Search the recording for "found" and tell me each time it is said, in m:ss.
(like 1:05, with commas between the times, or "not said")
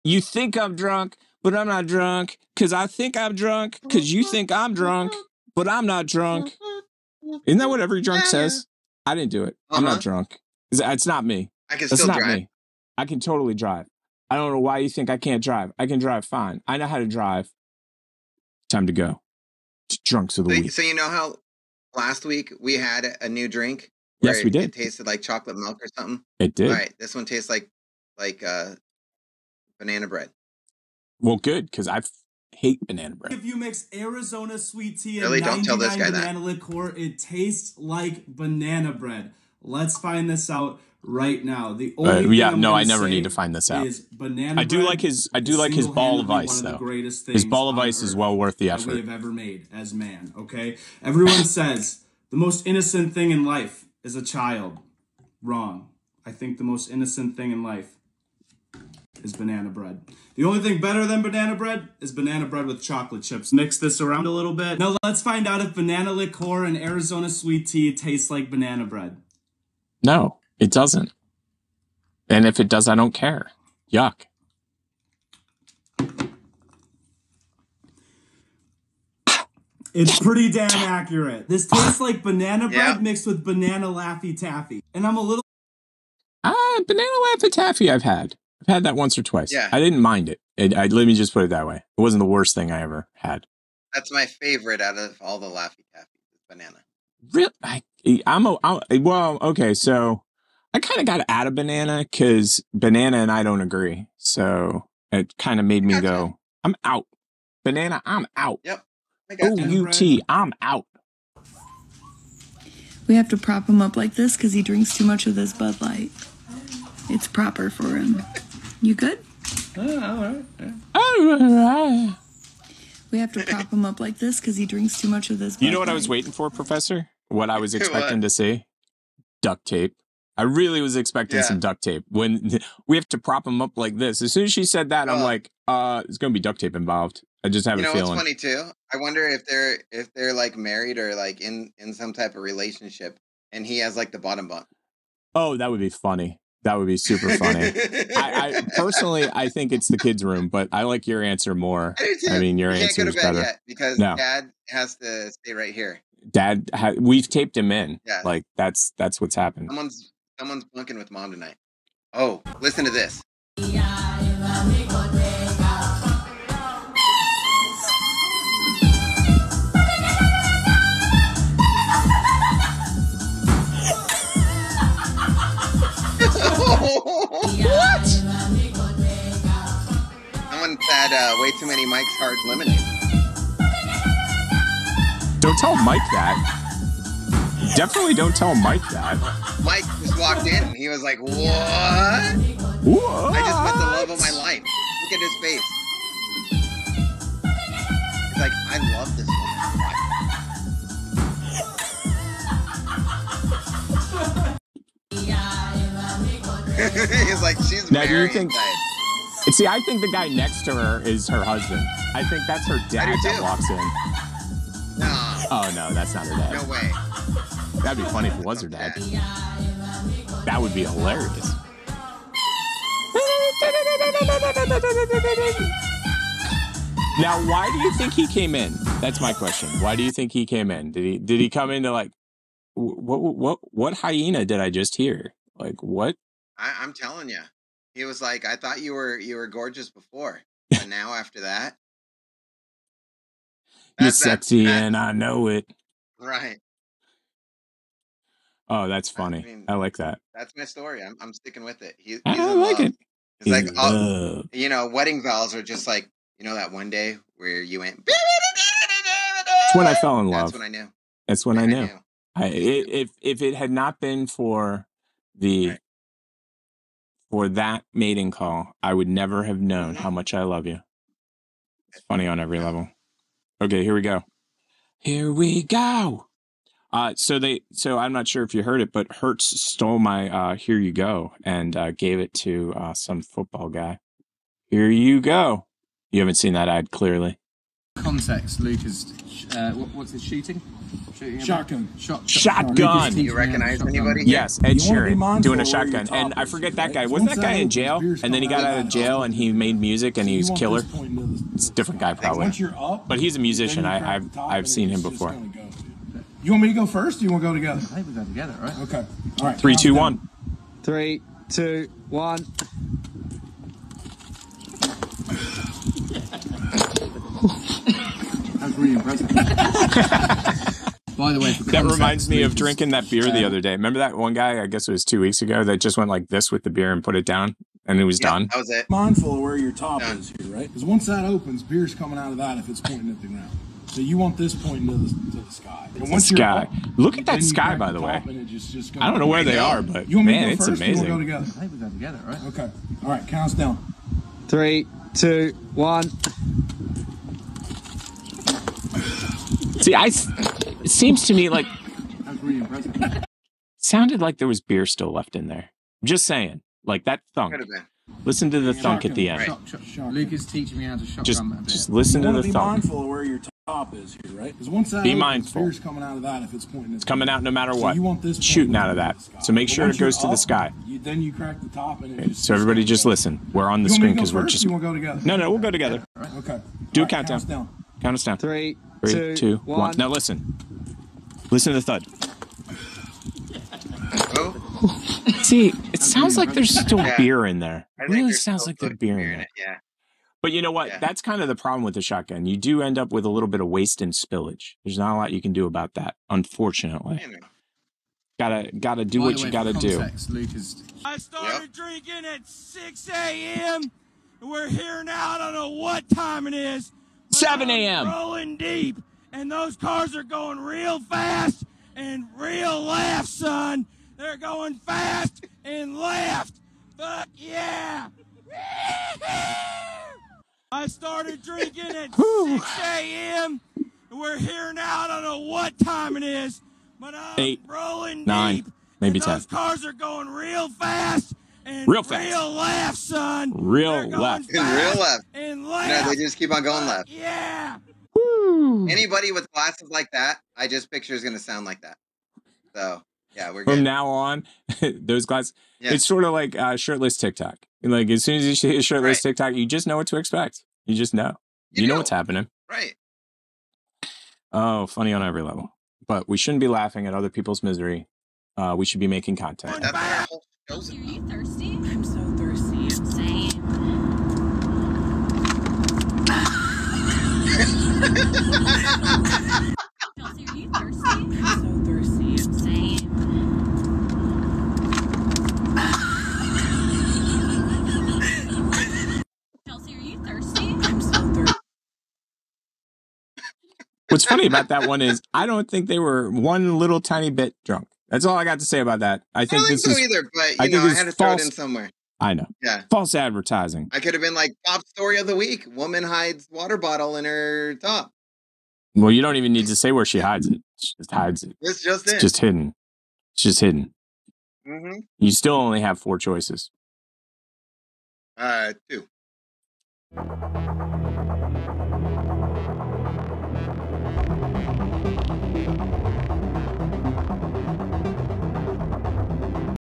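not said.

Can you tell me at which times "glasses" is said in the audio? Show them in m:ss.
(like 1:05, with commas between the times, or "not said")
7:19, 7:25.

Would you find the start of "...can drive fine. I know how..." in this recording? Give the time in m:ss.
0:15.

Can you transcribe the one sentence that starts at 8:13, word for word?
I could have been like top story of the week: woman hides water bottle in her top.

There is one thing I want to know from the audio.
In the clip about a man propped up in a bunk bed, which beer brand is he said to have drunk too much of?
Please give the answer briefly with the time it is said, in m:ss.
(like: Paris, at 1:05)
Bud Light, at 1:55.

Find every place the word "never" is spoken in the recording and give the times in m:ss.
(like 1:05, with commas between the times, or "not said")
0:42, 4:29.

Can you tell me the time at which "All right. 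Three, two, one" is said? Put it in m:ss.
5:09.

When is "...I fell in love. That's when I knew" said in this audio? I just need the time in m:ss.
4:19.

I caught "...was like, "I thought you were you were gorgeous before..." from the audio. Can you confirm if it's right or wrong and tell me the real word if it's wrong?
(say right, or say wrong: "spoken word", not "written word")
right.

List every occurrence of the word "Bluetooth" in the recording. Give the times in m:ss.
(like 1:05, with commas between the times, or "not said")
not said.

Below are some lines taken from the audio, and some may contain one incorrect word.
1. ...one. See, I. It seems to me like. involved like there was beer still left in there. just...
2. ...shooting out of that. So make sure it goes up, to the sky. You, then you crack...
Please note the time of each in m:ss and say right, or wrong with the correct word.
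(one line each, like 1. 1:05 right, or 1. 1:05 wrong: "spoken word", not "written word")
1. 5:45 wrong: "sounded", not "involved"
2. 6:08 right.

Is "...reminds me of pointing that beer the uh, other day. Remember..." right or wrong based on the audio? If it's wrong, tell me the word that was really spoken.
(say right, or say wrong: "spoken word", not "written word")
wrong: "drinking", not "pointing".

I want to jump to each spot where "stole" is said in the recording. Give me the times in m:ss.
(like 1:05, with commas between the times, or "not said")
4:39.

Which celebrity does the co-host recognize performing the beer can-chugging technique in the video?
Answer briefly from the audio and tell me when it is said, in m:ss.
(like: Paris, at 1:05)
Ed Sheeran, at 4:54.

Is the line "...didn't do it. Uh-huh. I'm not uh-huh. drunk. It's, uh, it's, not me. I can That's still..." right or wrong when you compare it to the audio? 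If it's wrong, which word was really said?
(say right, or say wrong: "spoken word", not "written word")
right.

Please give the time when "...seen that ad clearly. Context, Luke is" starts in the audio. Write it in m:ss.
4:46.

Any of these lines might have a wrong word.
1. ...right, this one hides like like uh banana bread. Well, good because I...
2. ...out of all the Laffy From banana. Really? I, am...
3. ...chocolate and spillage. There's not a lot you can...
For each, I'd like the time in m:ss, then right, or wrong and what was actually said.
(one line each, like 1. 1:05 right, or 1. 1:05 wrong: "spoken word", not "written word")
1. 0:26 wrong: "tastes", not "hides"
2. 1:34 wrong: "Taffy", not "From"
3. 6:33 wrong: "waste", not "chocolate".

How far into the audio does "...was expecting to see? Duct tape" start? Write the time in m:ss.
2:07.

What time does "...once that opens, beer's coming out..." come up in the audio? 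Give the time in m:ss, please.
5:30.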